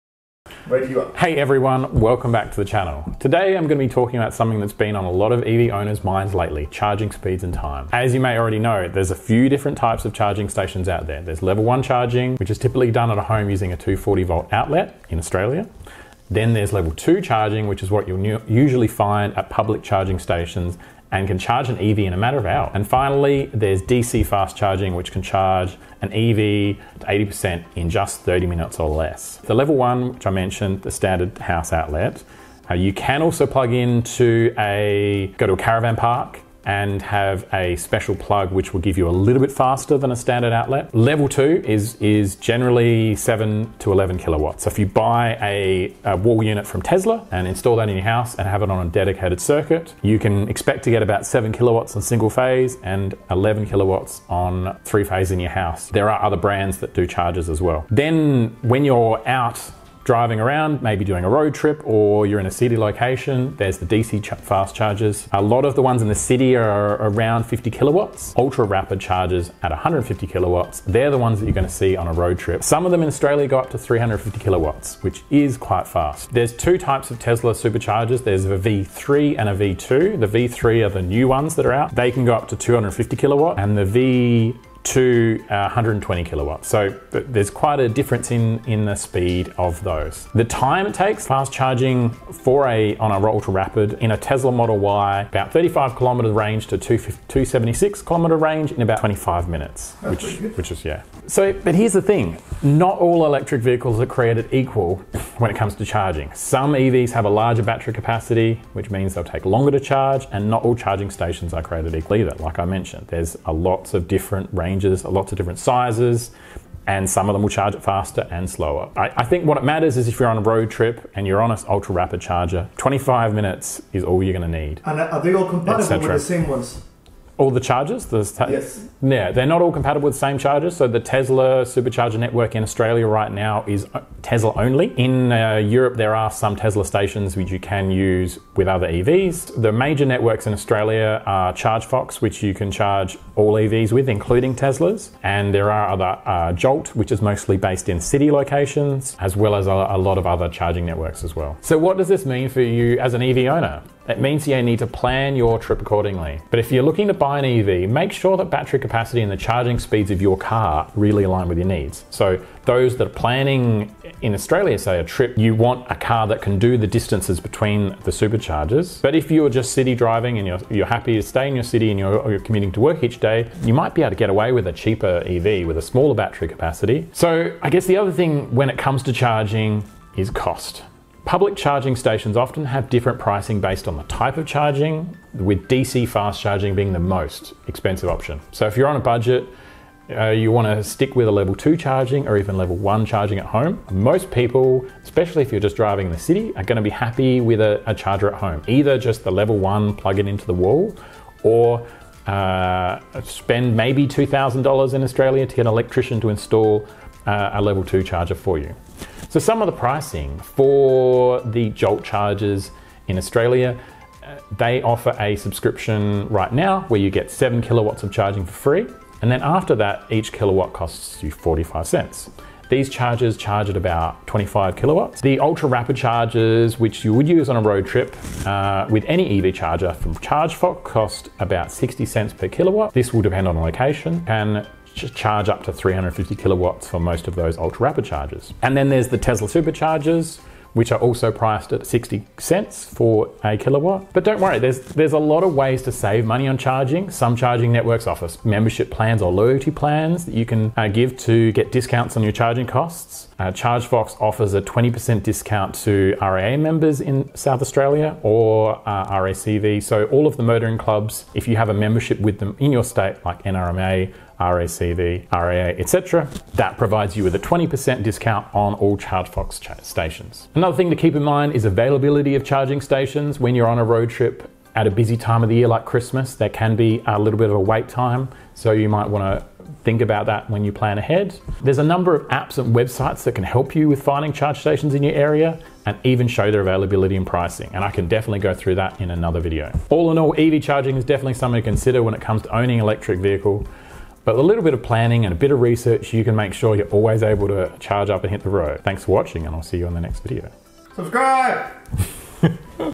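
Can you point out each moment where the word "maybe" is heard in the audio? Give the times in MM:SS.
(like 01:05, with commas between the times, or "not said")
01:00, 03:23.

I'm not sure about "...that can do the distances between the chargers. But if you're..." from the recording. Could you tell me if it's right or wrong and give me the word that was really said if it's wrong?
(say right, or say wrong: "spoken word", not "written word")
wrong: "superchargers", not "chargers".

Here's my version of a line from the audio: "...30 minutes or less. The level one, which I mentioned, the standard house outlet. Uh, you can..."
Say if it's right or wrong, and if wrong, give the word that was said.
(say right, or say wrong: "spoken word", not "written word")
right.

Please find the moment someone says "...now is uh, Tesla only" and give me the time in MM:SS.
02:13.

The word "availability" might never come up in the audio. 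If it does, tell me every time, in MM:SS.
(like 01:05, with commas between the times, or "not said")
04:31, 04:46.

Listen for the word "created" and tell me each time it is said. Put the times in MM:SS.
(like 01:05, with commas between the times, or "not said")
01:44, 01:51.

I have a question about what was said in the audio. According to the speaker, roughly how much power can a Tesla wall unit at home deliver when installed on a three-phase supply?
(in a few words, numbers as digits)
11 kilowatts.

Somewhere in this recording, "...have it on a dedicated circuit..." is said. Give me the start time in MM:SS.
00:48.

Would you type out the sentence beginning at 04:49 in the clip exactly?
All in all, EV charging is definitely something to consider when it comes to owning an electric vehicle.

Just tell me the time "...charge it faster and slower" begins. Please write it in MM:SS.
01:57.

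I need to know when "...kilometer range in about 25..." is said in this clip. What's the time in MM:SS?
01:38.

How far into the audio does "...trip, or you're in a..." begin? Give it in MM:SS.
01:01.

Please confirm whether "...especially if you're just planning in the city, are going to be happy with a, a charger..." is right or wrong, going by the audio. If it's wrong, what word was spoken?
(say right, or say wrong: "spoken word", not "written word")
wrong: "driving", not "planning".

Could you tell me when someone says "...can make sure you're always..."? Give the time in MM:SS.
04:56.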